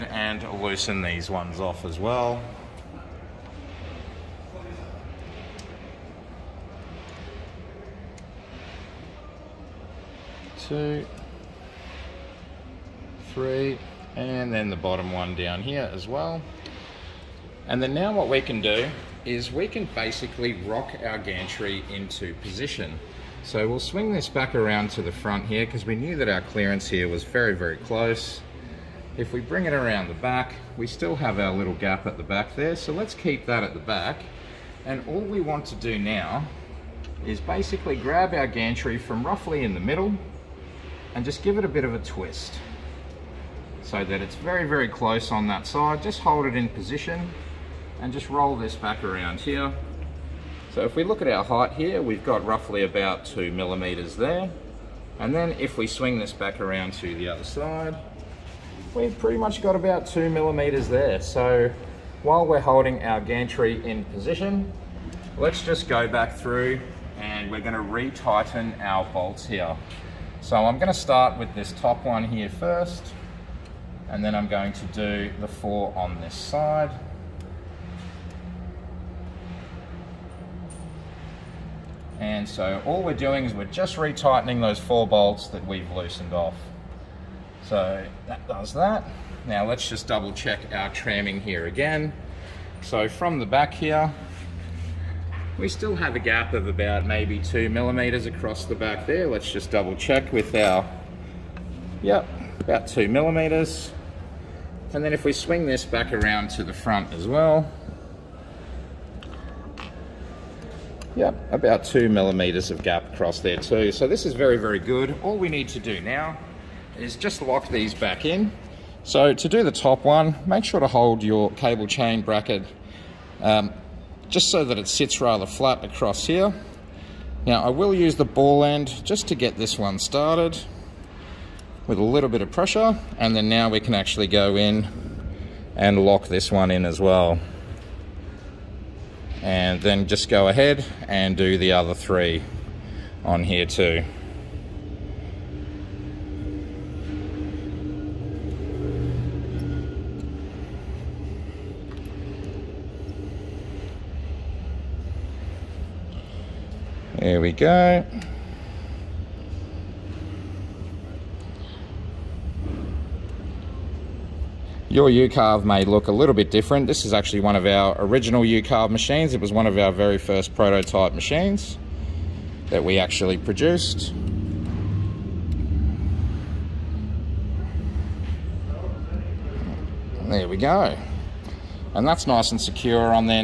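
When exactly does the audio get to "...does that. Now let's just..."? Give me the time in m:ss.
1:28.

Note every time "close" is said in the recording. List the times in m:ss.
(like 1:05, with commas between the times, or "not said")
0:27, 0:44.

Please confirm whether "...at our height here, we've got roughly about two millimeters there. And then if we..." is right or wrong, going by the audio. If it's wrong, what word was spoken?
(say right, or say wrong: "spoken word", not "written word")
right.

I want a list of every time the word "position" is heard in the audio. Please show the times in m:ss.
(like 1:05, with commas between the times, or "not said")
0:22, 0:46, 1:04.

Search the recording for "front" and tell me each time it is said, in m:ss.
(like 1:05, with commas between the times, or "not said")
0:25, 1:46.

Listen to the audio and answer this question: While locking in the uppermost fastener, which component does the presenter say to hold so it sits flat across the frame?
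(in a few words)
Cable chain bracket.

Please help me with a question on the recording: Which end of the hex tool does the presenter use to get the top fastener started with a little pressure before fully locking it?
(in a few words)
The ball end.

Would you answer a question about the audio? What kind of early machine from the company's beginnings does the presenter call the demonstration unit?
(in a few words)
Prototype machines.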